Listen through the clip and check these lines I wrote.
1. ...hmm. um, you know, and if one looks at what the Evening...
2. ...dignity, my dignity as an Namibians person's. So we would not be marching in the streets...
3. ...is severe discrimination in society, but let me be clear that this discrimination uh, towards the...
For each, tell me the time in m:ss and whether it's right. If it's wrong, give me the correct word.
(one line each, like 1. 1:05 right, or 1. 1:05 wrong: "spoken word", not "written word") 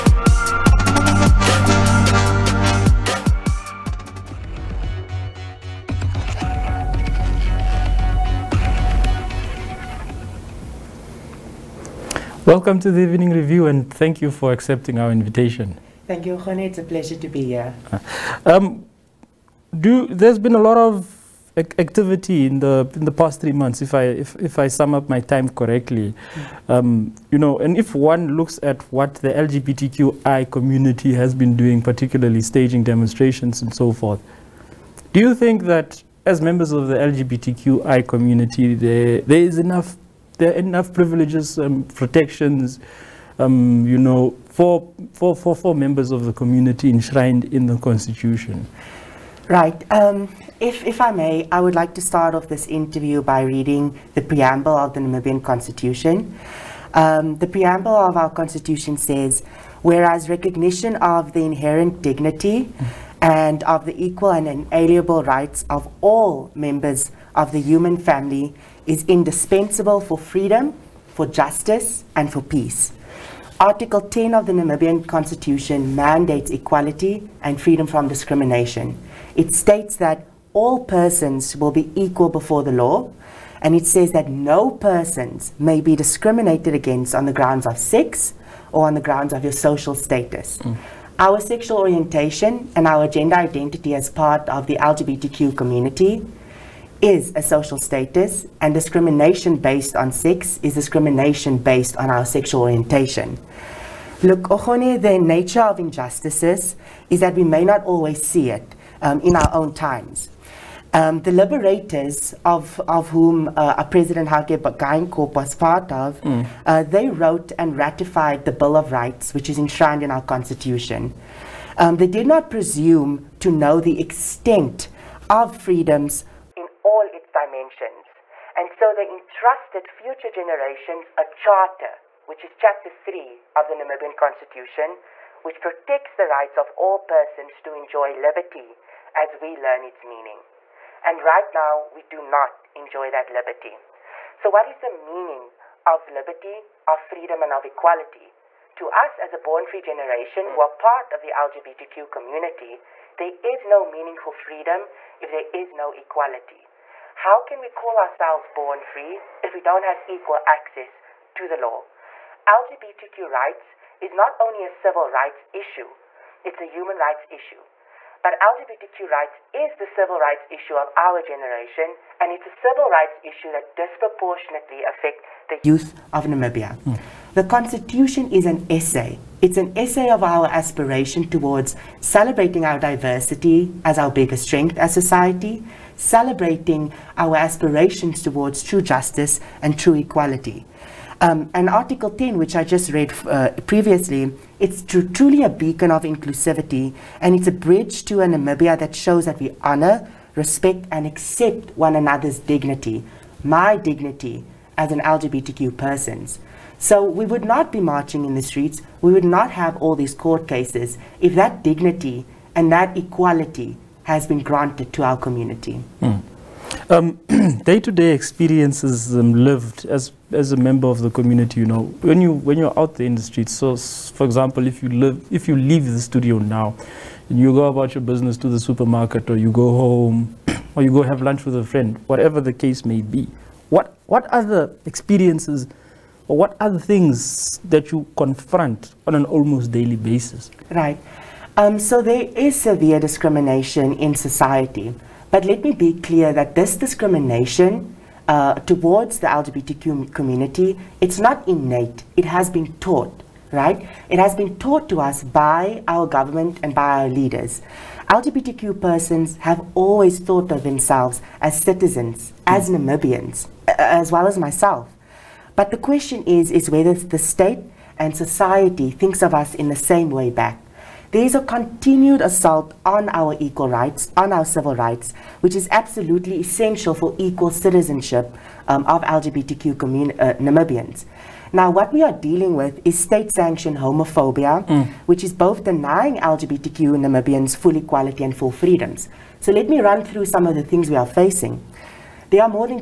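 1. 0:26 wrong: "LGBTQI", not "Evening"
2. 3:22 wrong: "LGBTQ", not "Namibians"
3. 4:02 right.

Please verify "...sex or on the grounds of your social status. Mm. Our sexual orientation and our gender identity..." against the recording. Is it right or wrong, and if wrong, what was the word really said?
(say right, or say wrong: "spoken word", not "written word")
right.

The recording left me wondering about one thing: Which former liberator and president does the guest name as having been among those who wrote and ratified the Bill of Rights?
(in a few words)
Hage Geingob.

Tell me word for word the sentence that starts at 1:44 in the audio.
Look, Ochone, the nature of injustices is that we may not always see it um, in our own times.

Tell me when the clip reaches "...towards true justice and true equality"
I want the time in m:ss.
3:08.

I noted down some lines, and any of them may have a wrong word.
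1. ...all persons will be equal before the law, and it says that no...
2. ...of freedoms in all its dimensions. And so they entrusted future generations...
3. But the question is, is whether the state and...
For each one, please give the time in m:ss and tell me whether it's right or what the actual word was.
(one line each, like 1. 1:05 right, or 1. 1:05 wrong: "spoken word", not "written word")
1. 1:20 right
2. 2:05 right
3. 4:25 right.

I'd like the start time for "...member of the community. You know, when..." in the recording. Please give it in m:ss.
3:40.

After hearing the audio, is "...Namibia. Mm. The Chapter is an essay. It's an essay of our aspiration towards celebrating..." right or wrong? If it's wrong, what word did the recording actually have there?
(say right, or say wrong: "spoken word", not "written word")
wrong: "Constitution", not "Chapter".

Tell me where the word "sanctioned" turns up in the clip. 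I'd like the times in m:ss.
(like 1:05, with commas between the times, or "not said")
4:43.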